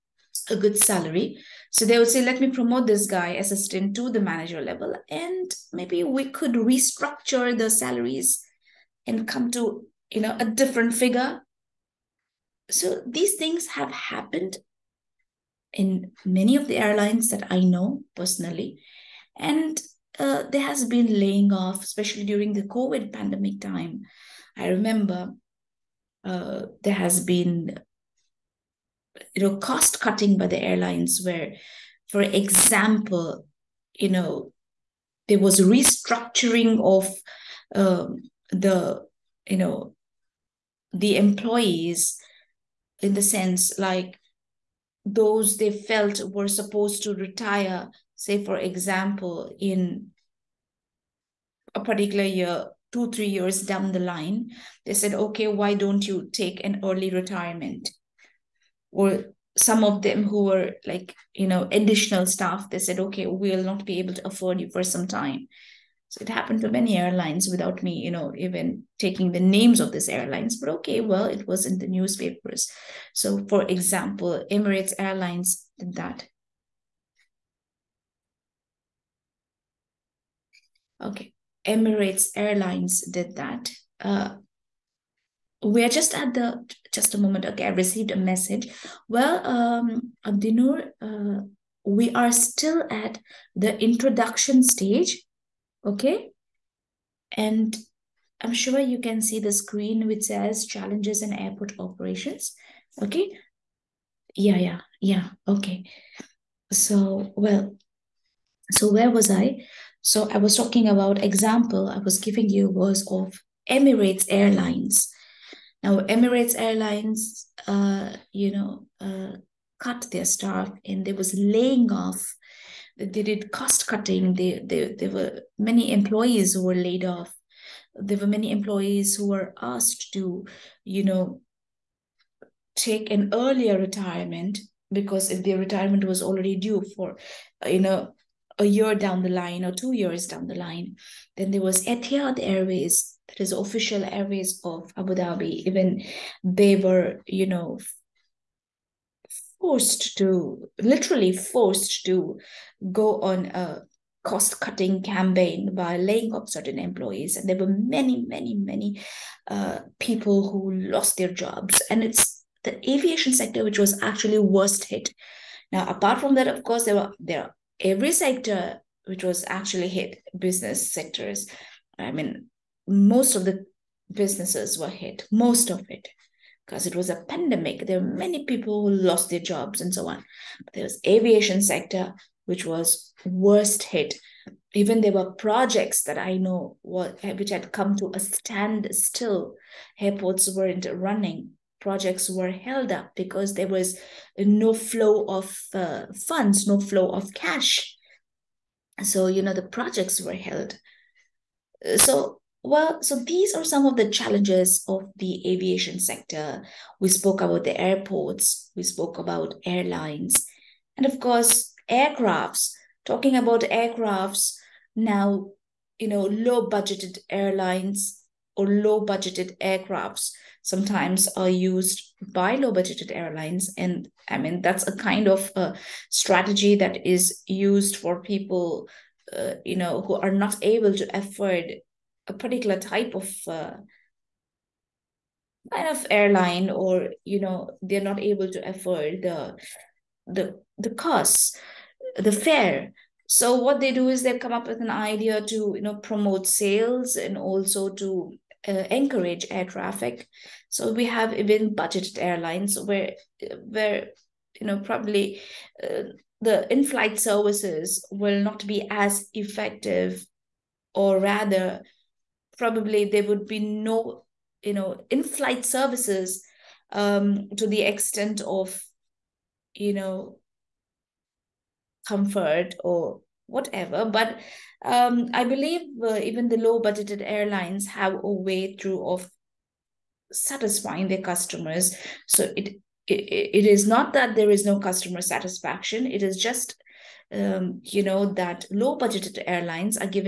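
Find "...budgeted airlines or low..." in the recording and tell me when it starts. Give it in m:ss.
3:36.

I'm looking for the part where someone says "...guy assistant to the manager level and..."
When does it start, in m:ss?
0:03.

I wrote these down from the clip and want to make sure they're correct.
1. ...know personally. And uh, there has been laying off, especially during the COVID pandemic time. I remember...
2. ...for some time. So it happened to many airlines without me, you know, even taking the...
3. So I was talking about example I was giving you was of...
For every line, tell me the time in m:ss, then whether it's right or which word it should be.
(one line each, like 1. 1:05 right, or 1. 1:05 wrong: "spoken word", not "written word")
1. 0:17 right
2. 1:04 right
3. 1:50 right.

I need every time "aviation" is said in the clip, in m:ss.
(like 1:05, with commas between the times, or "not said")
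2:42, 3:01, 3:25.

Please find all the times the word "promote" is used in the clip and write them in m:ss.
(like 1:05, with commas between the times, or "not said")
0:02, 4:05.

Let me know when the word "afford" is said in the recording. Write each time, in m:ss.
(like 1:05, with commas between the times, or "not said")
1:04, 3:51, 3:58.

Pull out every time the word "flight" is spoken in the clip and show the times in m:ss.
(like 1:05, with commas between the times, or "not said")
4:16, 4:25.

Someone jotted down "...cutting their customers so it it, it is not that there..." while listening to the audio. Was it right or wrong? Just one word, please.
wrong.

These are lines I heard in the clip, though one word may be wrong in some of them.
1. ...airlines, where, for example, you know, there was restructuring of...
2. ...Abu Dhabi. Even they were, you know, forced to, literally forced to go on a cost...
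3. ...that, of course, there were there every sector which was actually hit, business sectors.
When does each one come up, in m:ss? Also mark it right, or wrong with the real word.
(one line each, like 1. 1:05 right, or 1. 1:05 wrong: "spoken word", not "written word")
1. 0:30 right
2. 2:24 right
3. 2:46 right.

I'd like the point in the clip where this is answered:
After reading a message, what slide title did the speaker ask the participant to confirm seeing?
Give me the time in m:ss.
1:40.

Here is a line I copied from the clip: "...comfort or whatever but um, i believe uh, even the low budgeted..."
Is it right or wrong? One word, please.
right.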